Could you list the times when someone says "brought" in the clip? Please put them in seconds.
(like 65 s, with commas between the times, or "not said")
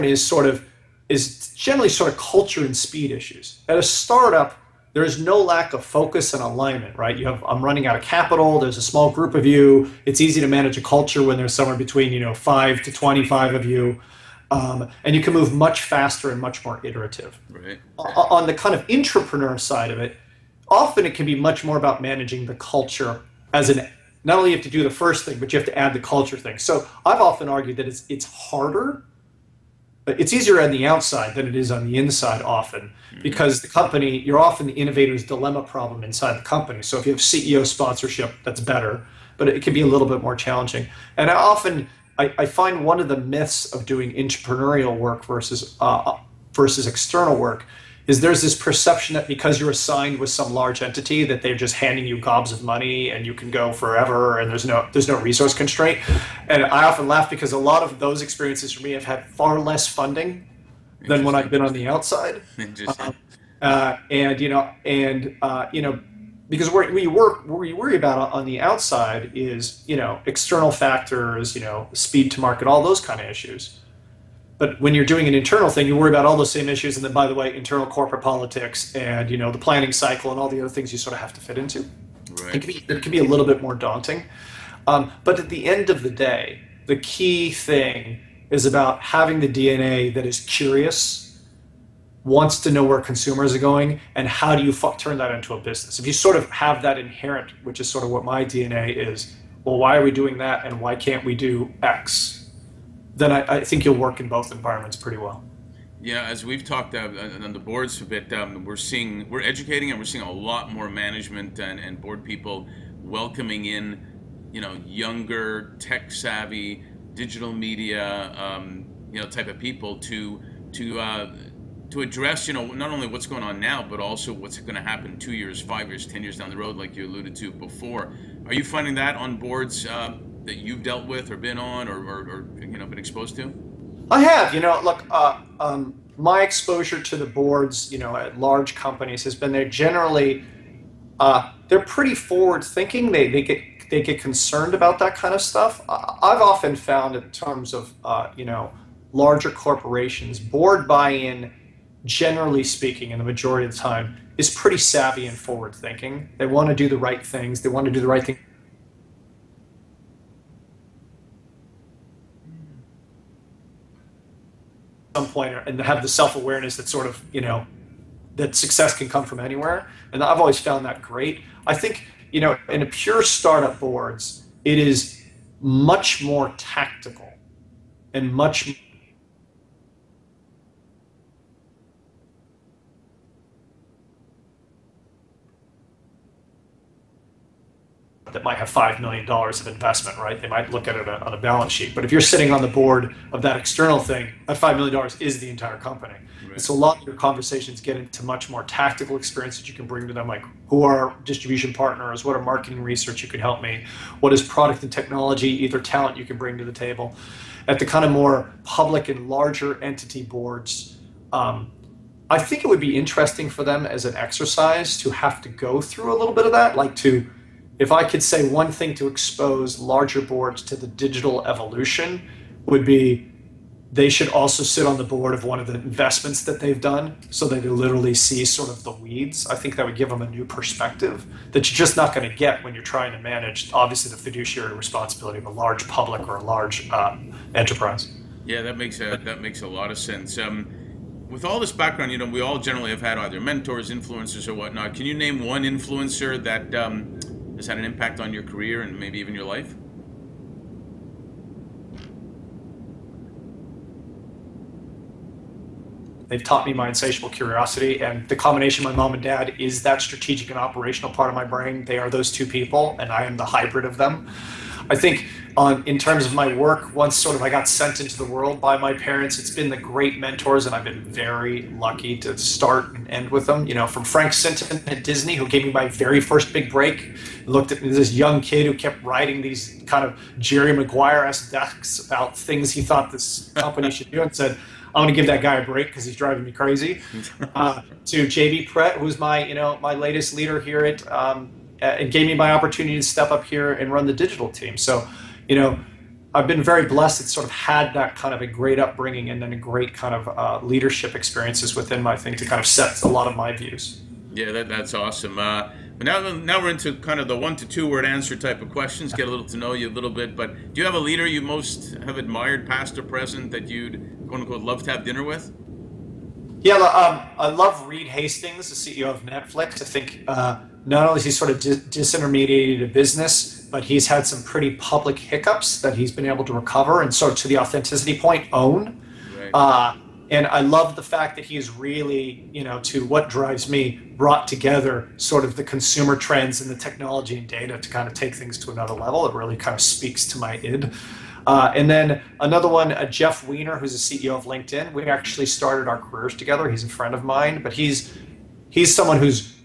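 334 s.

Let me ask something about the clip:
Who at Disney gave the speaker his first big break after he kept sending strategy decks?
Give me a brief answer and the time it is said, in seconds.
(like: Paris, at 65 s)
Frank Sinton, at 274 s.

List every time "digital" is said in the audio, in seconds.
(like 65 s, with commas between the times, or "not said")
117 s, 220 s, 294 s.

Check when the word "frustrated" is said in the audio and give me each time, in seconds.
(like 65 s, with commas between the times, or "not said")
not said.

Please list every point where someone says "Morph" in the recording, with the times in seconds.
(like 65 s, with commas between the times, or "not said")
not said.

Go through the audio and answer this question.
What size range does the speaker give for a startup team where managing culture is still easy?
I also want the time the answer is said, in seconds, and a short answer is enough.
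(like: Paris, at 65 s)
5 to 25, at 12 s.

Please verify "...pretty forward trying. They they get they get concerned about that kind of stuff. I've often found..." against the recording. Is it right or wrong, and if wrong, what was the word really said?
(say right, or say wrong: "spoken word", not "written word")
wrong: "thinking", not "trying".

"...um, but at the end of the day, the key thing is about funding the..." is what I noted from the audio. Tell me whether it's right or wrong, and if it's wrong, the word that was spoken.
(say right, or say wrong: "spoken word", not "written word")
wrong: "having", not "funding".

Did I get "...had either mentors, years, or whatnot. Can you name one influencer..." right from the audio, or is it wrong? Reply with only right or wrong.
wrong.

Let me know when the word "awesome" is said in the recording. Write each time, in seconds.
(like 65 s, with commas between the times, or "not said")
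304 s.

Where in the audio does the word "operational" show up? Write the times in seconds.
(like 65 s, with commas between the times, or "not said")
260 s.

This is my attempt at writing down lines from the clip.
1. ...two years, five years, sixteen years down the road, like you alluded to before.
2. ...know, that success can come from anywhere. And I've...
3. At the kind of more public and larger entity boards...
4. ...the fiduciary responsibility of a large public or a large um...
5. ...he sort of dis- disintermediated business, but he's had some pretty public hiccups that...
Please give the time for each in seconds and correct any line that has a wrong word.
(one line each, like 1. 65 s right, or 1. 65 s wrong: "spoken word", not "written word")
1. 125 s wrong: "ten", not "sixteen"
2. 167 s right
3. 207 s right
4. 234 s right
5. 321 s right.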